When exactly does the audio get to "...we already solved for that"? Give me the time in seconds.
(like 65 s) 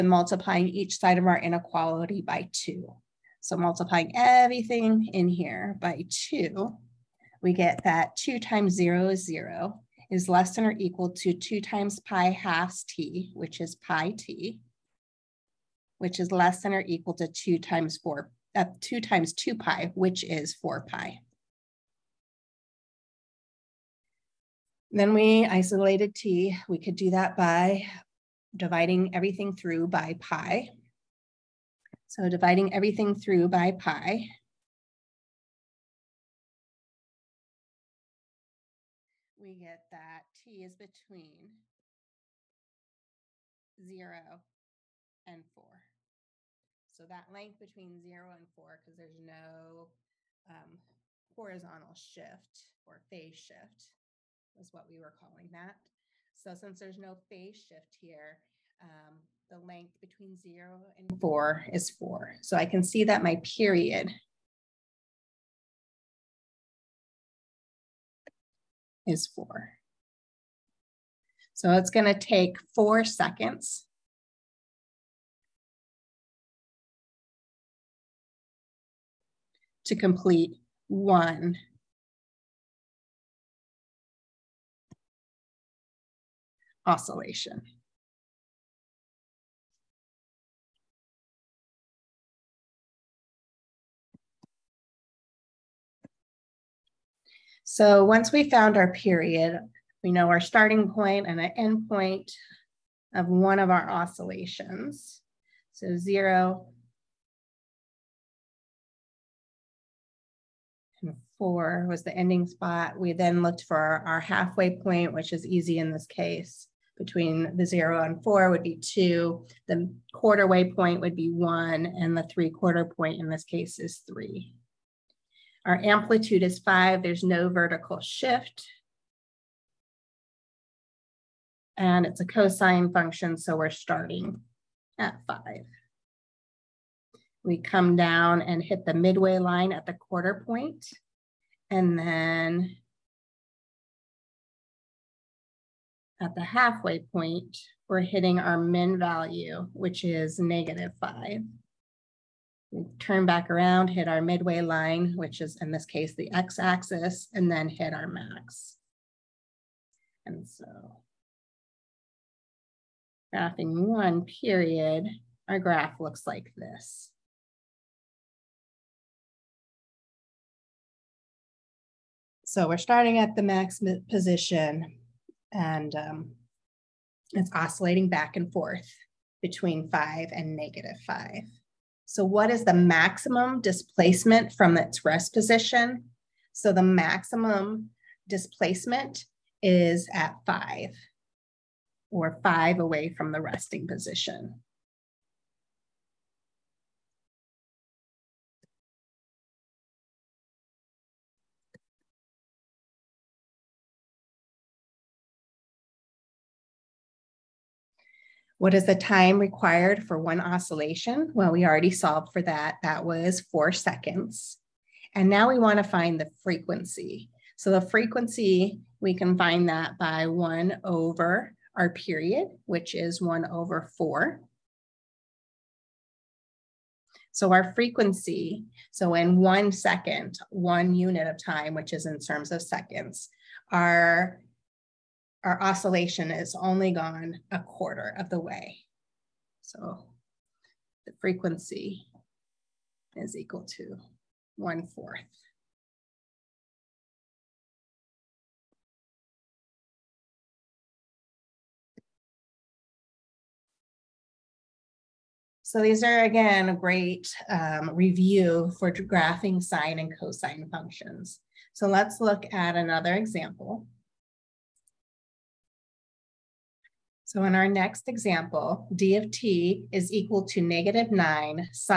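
211 s.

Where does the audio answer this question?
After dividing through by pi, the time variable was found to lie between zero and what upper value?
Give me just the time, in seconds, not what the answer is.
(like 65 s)
40 s.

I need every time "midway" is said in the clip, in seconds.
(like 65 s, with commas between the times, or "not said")
138 s, 154 s.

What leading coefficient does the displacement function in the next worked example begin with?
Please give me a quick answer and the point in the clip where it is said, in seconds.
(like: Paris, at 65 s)
-9, at 270 s.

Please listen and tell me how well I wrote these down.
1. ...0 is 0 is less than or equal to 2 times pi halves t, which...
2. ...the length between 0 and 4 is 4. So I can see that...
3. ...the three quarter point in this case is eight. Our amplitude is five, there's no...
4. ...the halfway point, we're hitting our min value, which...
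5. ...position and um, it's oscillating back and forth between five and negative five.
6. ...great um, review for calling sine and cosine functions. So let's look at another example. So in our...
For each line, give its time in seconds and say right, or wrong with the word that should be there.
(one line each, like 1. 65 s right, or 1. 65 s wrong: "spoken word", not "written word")
1. 8 s right
2. 59 s right
3. 122 s wrong: "three", not "eight"
4. 146 s right
5. 174 s right
6. 256 s wrong: "graphing", not "calling".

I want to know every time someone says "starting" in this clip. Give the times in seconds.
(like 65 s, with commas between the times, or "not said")
100 s, 133 s, 172 s.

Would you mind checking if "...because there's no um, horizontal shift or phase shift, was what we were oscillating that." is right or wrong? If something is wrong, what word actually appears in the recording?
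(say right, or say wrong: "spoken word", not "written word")
wrong: "calling", not "oscillating".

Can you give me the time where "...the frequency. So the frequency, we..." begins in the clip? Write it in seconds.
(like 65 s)
216 s.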